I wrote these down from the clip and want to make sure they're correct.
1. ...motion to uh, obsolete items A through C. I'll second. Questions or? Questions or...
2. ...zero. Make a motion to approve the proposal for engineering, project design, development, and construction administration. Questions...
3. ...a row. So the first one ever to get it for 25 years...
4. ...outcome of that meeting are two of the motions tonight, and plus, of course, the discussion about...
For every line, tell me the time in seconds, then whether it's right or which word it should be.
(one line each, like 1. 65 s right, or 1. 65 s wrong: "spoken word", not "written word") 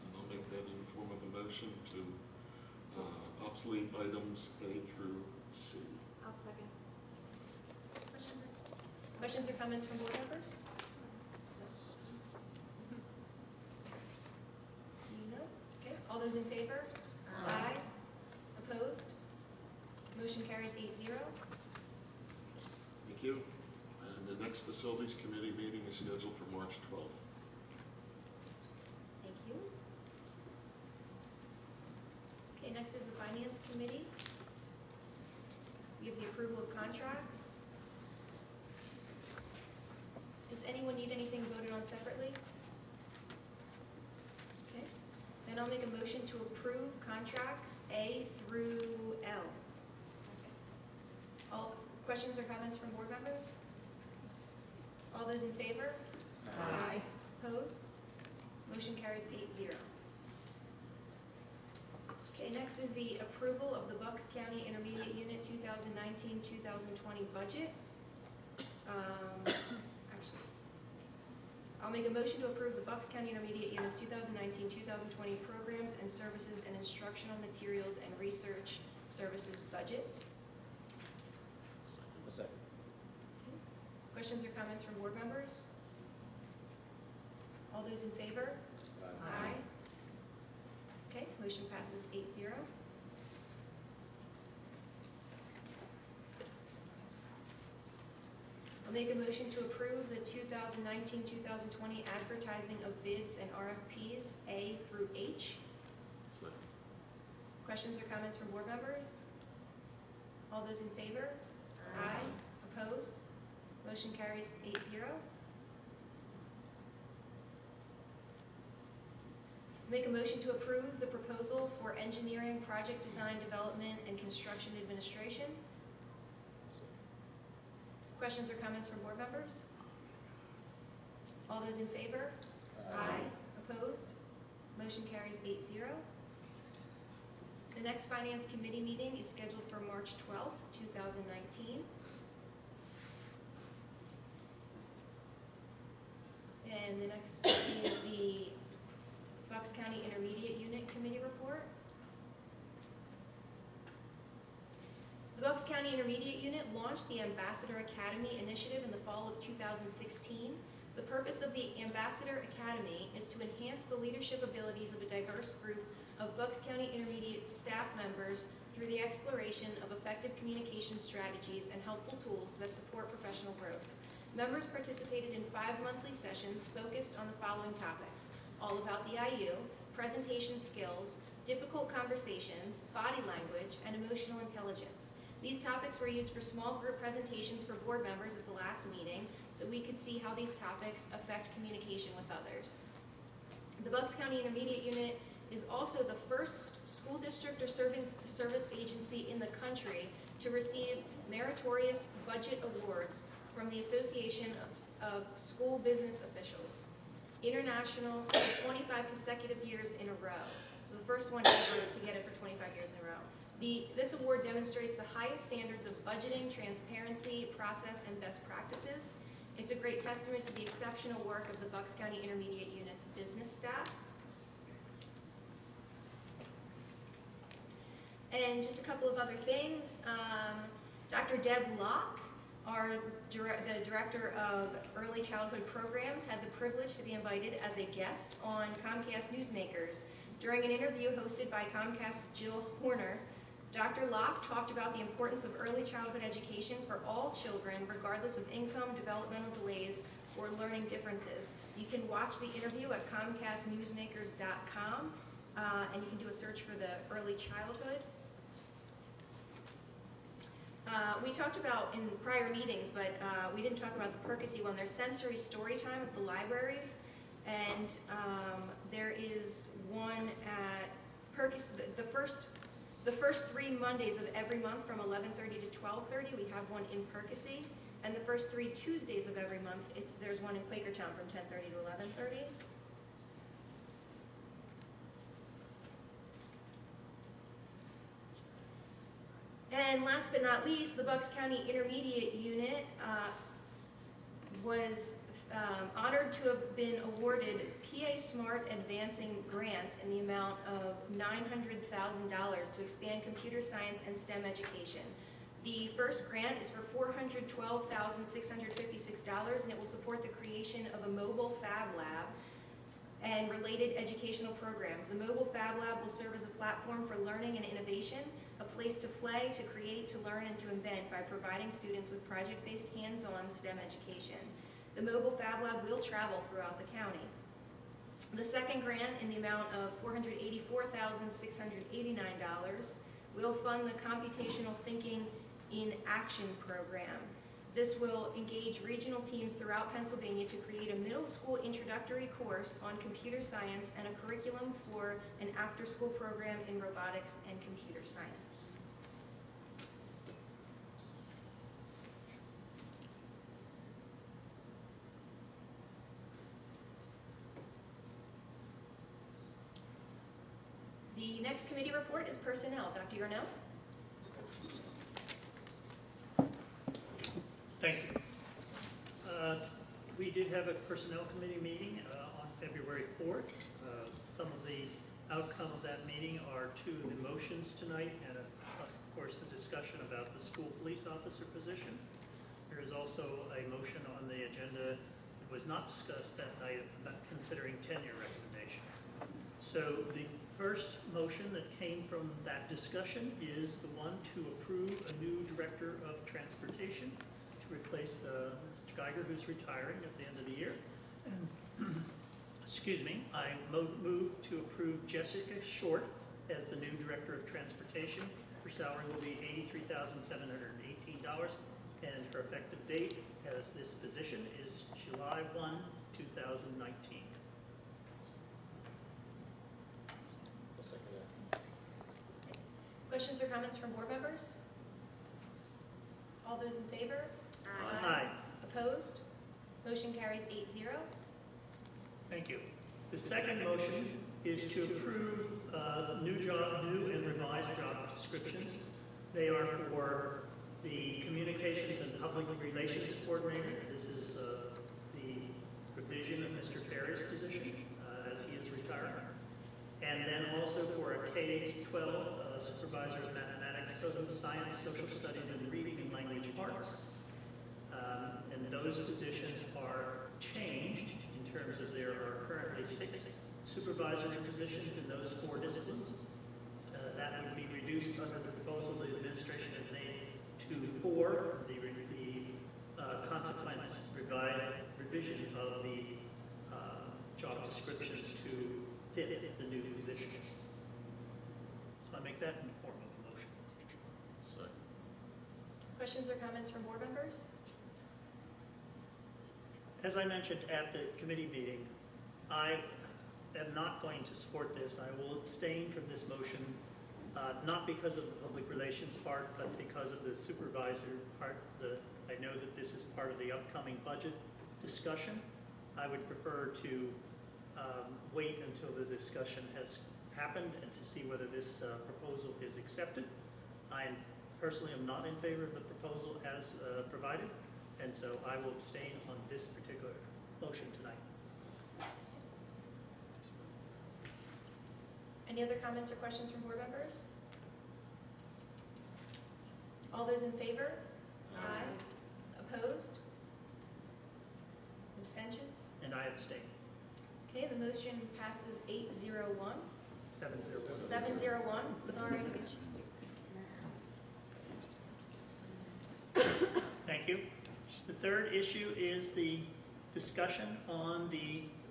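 1. 1 s right
2. 114 s right
3. 210 s right
4. 375 s right.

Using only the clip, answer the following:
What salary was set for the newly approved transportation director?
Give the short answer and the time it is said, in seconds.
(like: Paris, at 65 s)
$83,718, at 409 s.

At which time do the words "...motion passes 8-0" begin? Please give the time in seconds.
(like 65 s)
91 s.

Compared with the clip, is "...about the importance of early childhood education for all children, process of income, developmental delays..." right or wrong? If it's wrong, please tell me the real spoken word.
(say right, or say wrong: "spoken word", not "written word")
wrong: "regardless", not "process".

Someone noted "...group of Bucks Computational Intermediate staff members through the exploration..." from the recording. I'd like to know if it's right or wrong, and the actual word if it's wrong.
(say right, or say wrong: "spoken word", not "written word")
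wrong: "County", not "Computational".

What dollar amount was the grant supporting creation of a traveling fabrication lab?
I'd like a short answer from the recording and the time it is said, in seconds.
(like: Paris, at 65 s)
$412,656, at 307 s.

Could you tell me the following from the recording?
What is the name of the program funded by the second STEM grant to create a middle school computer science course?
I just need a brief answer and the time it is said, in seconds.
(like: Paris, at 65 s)
Computational Thinking in Action, at 334 s.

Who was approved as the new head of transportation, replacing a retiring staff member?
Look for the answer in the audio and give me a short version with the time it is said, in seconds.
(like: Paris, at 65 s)
Jessica Short, at 405 s.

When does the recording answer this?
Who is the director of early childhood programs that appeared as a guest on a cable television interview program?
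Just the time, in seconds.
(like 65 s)
231 s.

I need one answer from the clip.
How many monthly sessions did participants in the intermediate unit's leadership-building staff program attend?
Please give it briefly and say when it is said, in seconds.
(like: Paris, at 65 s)
5, at 175 s.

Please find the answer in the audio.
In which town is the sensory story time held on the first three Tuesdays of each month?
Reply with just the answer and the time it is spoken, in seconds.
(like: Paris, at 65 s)
Quakertown, at 280 s.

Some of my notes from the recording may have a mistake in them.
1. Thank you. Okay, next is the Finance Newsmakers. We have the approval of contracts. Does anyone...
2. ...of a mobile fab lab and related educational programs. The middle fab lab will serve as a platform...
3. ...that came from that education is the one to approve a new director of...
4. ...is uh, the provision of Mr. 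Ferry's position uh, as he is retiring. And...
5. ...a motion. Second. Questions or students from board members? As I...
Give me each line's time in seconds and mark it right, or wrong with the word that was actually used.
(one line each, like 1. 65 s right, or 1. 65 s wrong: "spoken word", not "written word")
1. 29 s wrong: "Committee", not "Newsmakers"
2. 310 s wrong: "mobile", not "middle"
3. 391 s wrong: "discussion", not "education"
4. 444 s right
5. 483 s wrong: "comments", not "students".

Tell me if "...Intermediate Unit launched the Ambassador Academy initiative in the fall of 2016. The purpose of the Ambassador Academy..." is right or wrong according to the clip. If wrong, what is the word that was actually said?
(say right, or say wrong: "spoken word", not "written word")
right.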